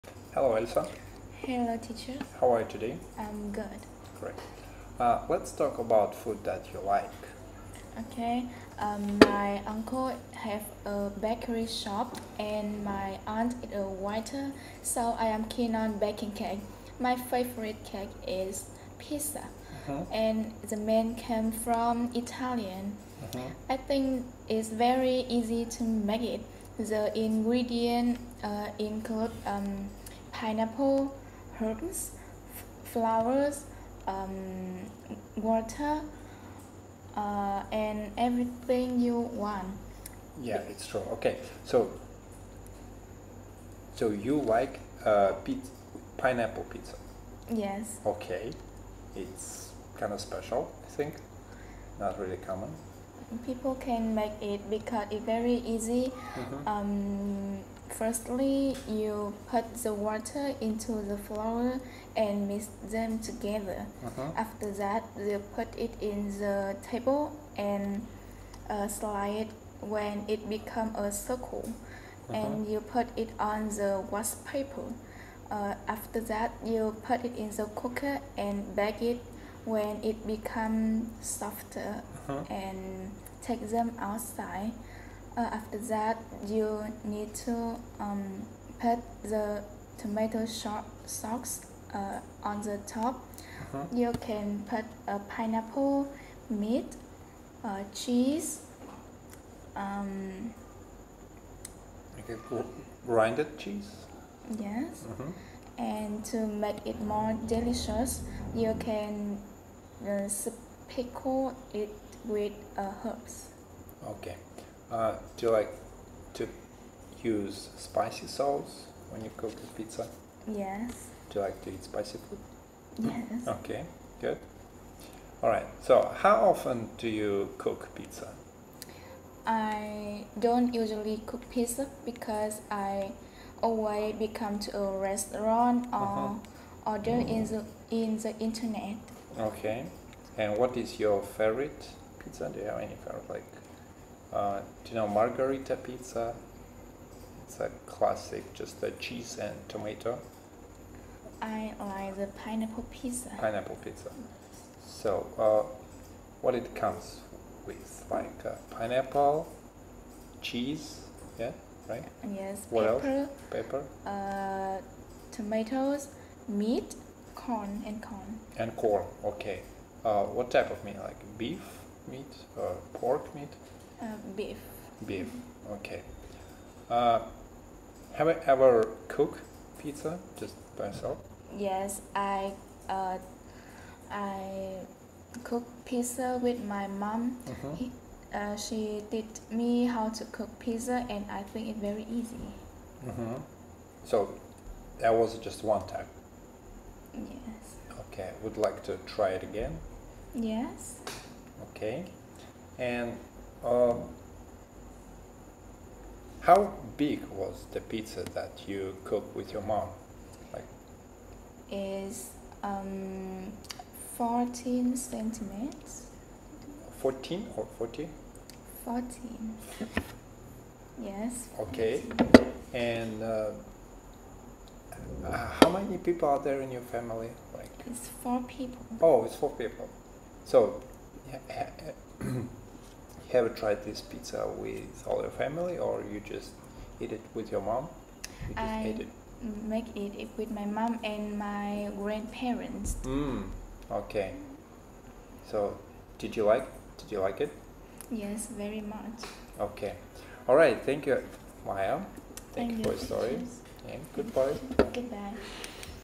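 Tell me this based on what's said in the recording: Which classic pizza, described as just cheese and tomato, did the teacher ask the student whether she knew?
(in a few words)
margarita pizza.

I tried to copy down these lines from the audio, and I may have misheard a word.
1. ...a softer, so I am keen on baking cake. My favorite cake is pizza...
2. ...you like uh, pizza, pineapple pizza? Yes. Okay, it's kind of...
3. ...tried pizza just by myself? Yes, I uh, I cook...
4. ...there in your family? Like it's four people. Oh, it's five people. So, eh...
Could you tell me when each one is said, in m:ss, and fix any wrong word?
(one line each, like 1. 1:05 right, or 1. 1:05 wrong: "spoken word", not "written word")
1. 0:13 wrong: "waiter", not "softer"
2. 0:44 right
3. 2:59 wrong: "cooked", not "tried"
4. 3:46 wrong: "four", not "five".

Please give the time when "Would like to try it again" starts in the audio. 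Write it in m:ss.
3:18.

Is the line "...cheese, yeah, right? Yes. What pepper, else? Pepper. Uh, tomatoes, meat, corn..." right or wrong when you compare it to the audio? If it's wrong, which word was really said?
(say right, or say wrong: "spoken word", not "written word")
right.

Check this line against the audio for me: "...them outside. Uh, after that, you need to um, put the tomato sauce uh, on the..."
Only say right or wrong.
right.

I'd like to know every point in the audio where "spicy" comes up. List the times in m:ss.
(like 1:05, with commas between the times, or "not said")
1:57, 2:01.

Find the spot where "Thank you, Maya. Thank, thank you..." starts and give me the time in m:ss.
4:10.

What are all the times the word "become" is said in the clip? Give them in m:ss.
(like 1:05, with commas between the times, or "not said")
1:10, 1:20, 2:14.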